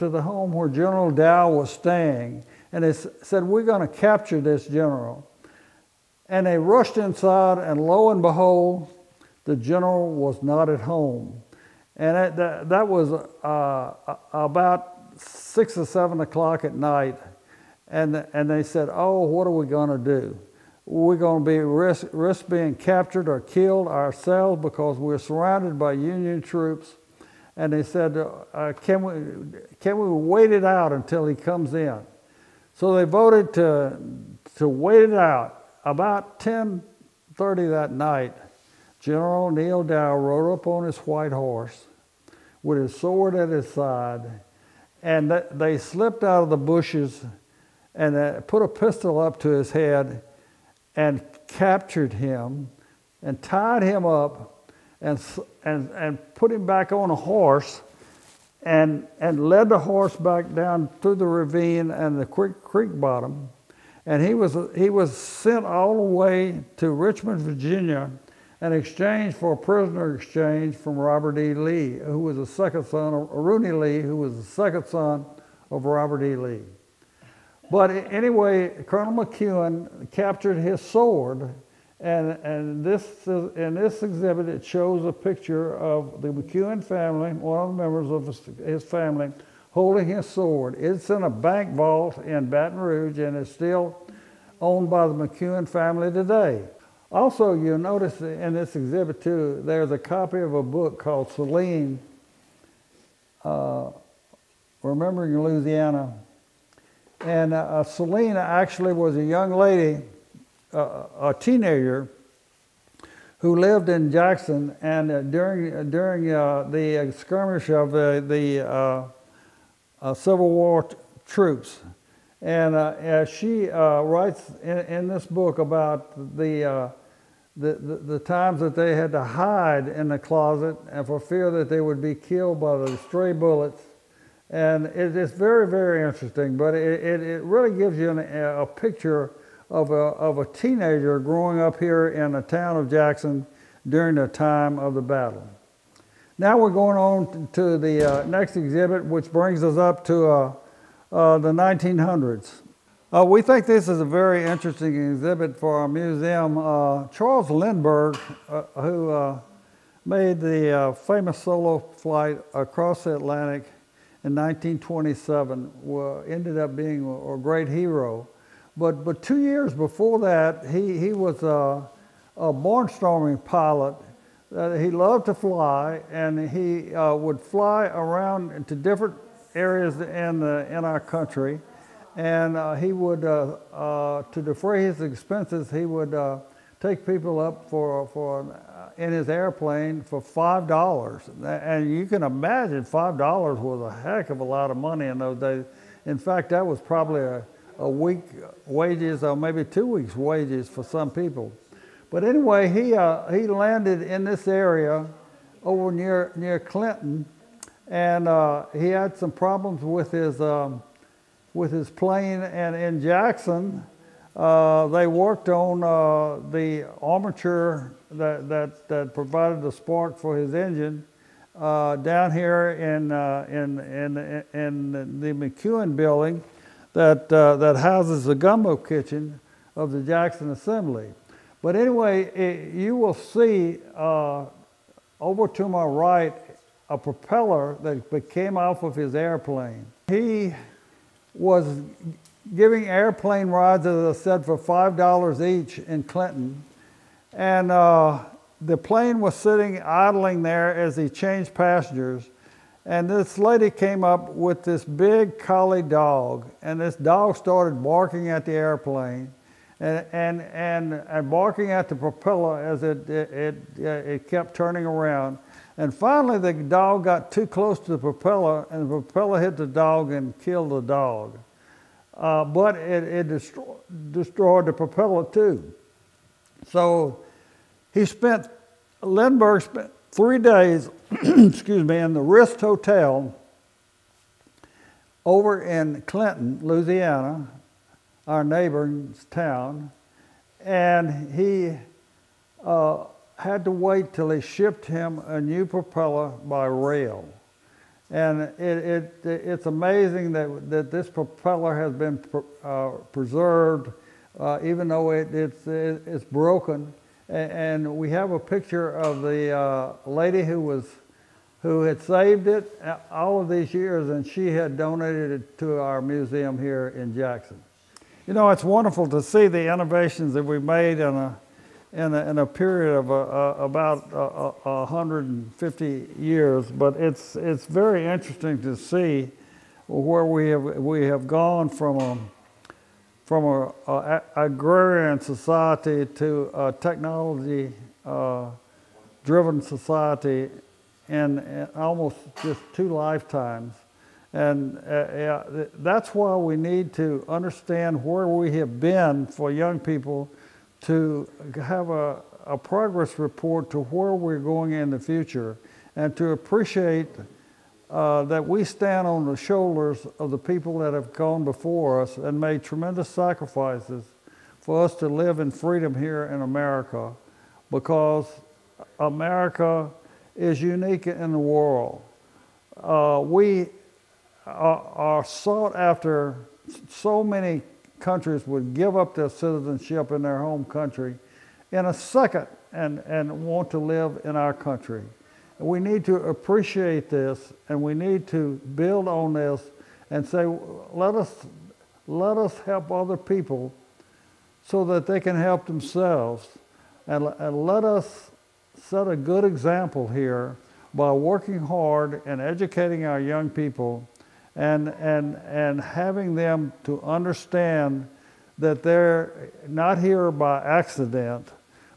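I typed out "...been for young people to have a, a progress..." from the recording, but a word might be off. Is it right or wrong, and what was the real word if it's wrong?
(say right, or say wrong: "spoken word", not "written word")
right.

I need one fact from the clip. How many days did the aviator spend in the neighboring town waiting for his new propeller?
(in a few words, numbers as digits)
3.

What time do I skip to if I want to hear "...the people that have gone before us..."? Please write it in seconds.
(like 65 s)
360 s.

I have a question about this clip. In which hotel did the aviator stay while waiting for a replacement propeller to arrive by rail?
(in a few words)
Rist Hotel.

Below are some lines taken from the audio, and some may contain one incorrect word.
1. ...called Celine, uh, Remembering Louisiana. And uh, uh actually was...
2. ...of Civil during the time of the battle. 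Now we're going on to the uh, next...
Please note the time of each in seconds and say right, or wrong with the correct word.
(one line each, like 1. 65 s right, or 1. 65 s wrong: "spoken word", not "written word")
1. 100 s right
2. 142 s wrong: "Jackson", not "Civil".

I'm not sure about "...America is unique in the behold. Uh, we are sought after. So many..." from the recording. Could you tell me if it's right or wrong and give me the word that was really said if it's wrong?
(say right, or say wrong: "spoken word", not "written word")
wrong: "world", not "behold".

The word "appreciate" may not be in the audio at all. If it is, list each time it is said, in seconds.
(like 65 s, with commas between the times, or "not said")
356 s, 386 s.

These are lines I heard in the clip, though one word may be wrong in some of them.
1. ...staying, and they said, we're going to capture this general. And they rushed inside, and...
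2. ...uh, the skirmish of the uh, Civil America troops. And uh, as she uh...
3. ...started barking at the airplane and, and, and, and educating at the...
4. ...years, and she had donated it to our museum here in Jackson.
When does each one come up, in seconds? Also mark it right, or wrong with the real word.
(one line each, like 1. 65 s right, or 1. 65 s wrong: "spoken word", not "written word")
1. 1 s right
2. 116 s wrong: "War", not "America"
3. 257 s wrong: "barking", not "educating"
4. 313 s right.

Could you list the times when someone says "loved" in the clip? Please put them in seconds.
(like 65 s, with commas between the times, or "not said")
174 s.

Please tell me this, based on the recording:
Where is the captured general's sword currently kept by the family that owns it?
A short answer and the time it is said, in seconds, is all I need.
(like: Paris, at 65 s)
A bank vault in Baton Rouge, at 91 s.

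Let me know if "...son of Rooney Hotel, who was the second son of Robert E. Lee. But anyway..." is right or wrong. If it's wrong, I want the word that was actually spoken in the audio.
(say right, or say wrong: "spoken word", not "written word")
wrong: "Lee", not "Hotel".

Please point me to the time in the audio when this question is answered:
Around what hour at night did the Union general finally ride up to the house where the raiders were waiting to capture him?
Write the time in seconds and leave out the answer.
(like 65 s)
36 s.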